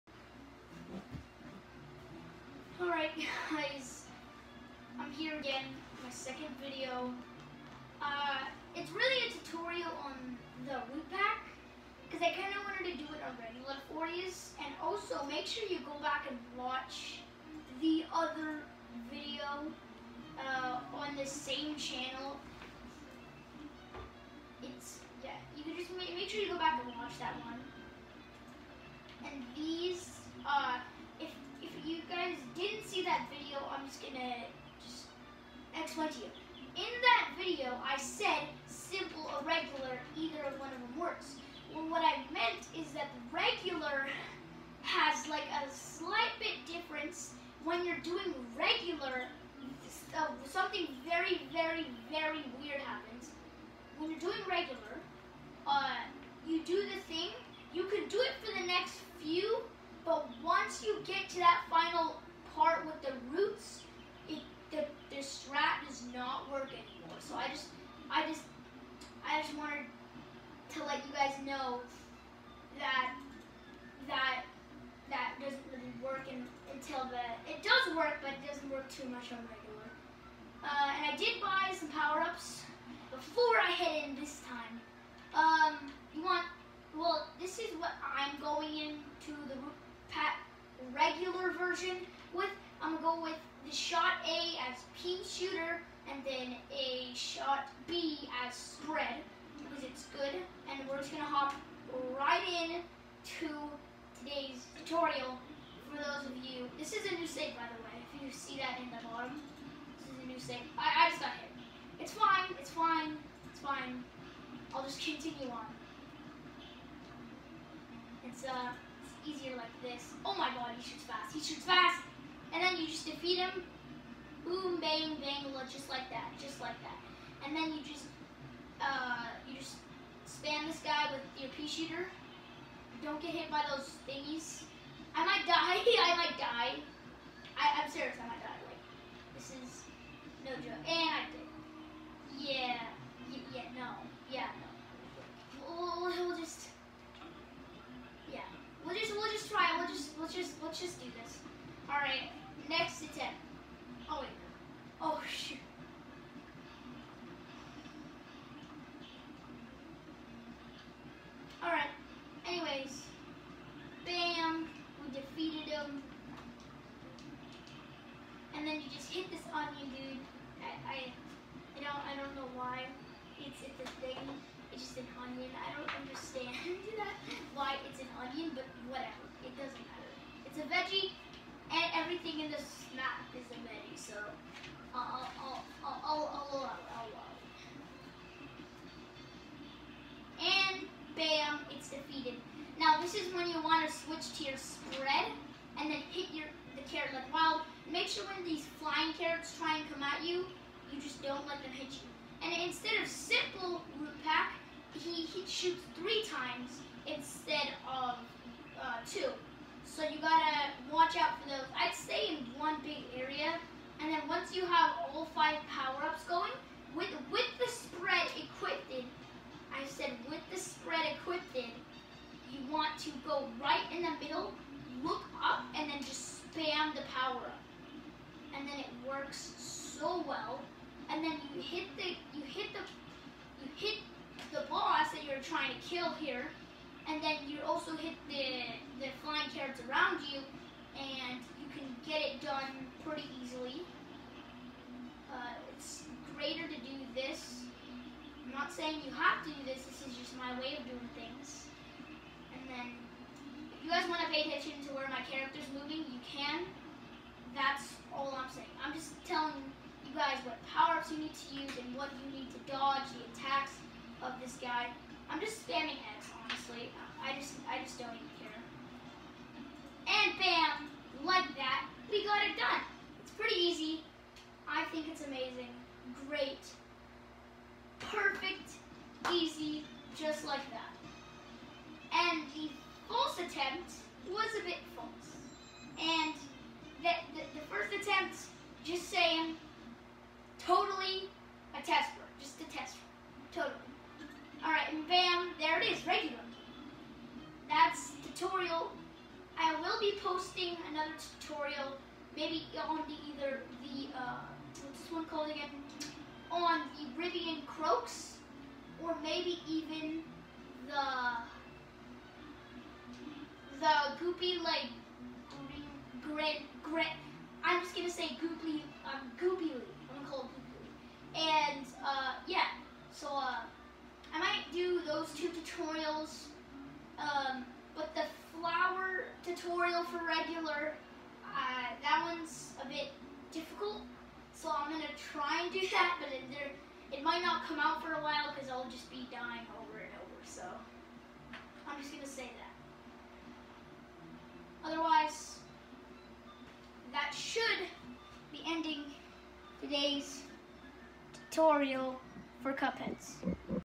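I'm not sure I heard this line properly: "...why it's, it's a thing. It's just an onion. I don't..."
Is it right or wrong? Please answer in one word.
right.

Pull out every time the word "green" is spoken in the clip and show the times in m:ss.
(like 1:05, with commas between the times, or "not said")
5:16.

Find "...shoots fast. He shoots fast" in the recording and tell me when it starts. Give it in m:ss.
2:00.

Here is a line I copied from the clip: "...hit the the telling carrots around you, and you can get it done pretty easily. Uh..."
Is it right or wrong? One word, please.
wrong.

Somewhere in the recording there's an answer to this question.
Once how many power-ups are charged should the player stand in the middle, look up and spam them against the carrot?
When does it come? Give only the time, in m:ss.
3:35.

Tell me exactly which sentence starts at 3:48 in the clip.
And then it works so well.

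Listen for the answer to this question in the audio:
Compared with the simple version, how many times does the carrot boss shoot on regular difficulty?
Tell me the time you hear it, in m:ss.
3:26.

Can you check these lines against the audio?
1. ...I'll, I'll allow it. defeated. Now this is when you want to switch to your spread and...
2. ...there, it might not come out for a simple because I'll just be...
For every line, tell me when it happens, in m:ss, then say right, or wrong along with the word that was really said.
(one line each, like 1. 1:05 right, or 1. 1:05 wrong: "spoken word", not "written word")
1. 3:06 right
2. 5:36 wrong: "while", not "simple".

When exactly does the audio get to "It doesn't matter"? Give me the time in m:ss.
2:59.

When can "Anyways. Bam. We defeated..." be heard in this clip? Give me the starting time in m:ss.
2:42.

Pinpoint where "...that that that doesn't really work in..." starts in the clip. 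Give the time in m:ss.
1:12.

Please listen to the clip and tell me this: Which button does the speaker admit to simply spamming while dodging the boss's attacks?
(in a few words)
X.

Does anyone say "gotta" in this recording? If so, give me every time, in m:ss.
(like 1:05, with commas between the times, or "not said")
3:30.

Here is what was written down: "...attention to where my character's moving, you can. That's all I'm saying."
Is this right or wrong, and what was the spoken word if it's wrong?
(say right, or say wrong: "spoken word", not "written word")
right.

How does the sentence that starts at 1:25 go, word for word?
Um, you want well, this is what I'm going into the regular version with.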